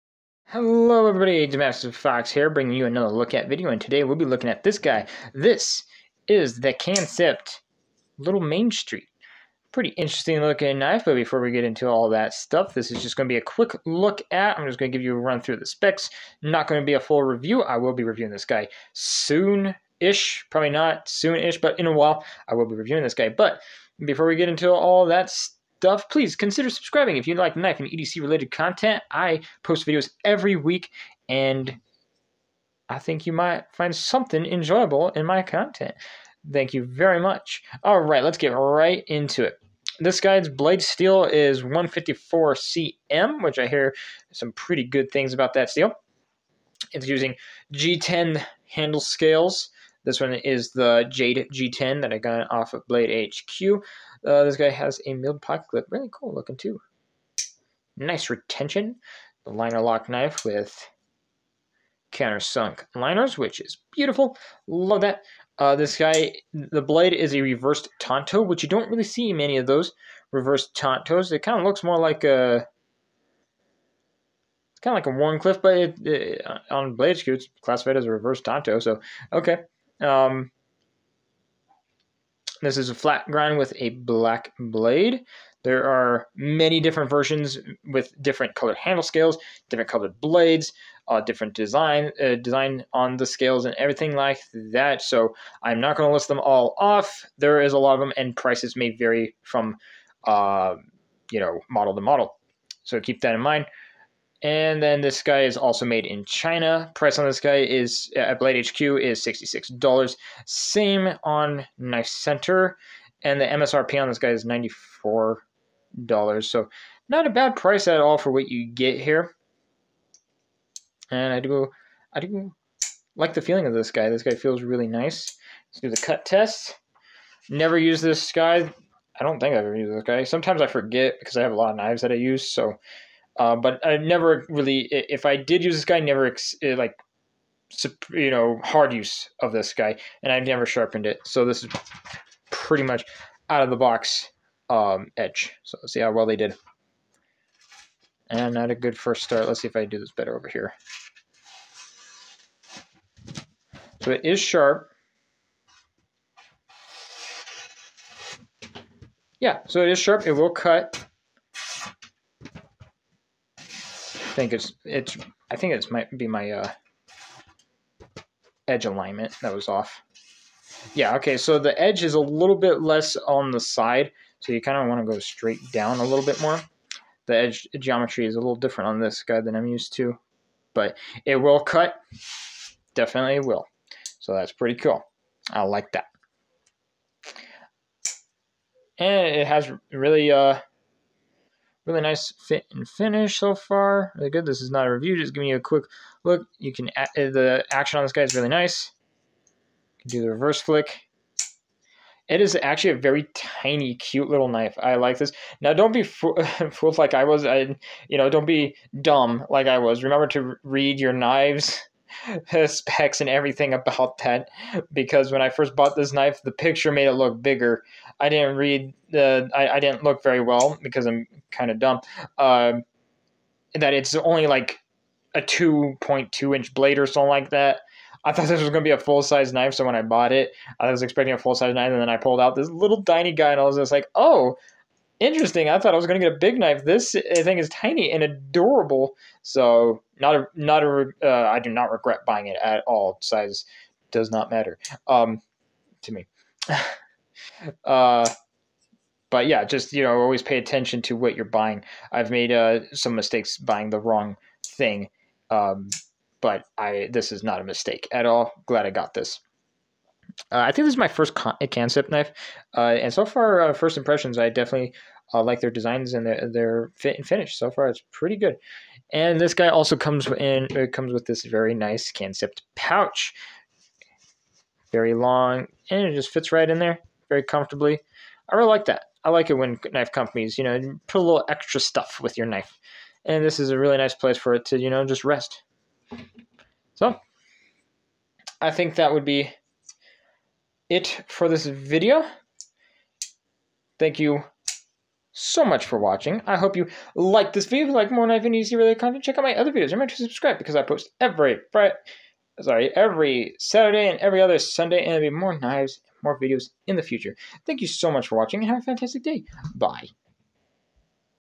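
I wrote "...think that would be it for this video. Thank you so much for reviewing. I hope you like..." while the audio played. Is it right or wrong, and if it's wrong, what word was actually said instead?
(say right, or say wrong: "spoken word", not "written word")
wrong: "watching", not "reviewing".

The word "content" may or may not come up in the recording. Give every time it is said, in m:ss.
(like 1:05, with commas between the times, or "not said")
0:28, 0:35, 4:58.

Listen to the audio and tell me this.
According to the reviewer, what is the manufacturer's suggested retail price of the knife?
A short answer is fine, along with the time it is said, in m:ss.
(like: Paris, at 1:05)
$94, at 1:54.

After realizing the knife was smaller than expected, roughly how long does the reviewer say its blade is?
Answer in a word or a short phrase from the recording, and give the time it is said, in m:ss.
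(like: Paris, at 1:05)
2.2 inches, at 3:45.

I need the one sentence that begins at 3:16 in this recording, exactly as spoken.
You can uh, the action on this guy is really nice.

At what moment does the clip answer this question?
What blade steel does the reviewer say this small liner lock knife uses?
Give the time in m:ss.
0:41.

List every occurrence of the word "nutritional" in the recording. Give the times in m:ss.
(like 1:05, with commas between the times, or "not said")
not said.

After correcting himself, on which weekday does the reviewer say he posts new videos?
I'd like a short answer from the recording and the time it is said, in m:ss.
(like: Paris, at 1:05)
Saturday, at 5:02.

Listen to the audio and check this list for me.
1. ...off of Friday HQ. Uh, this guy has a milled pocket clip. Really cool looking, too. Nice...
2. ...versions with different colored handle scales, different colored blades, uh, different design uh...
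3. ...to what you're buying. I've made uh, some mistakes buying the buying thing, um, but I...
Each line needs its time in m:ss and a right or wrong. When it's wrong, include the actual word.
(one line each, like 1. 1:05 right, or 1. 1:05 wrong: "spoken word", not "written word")
1. 0:52 wrong: "Blade", not "Friday"
2. 1:27 right
3. 4:11 wrong: "wrong", not "buying".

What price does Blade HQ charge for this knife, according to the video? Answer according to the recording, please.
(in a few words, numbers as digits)
$66.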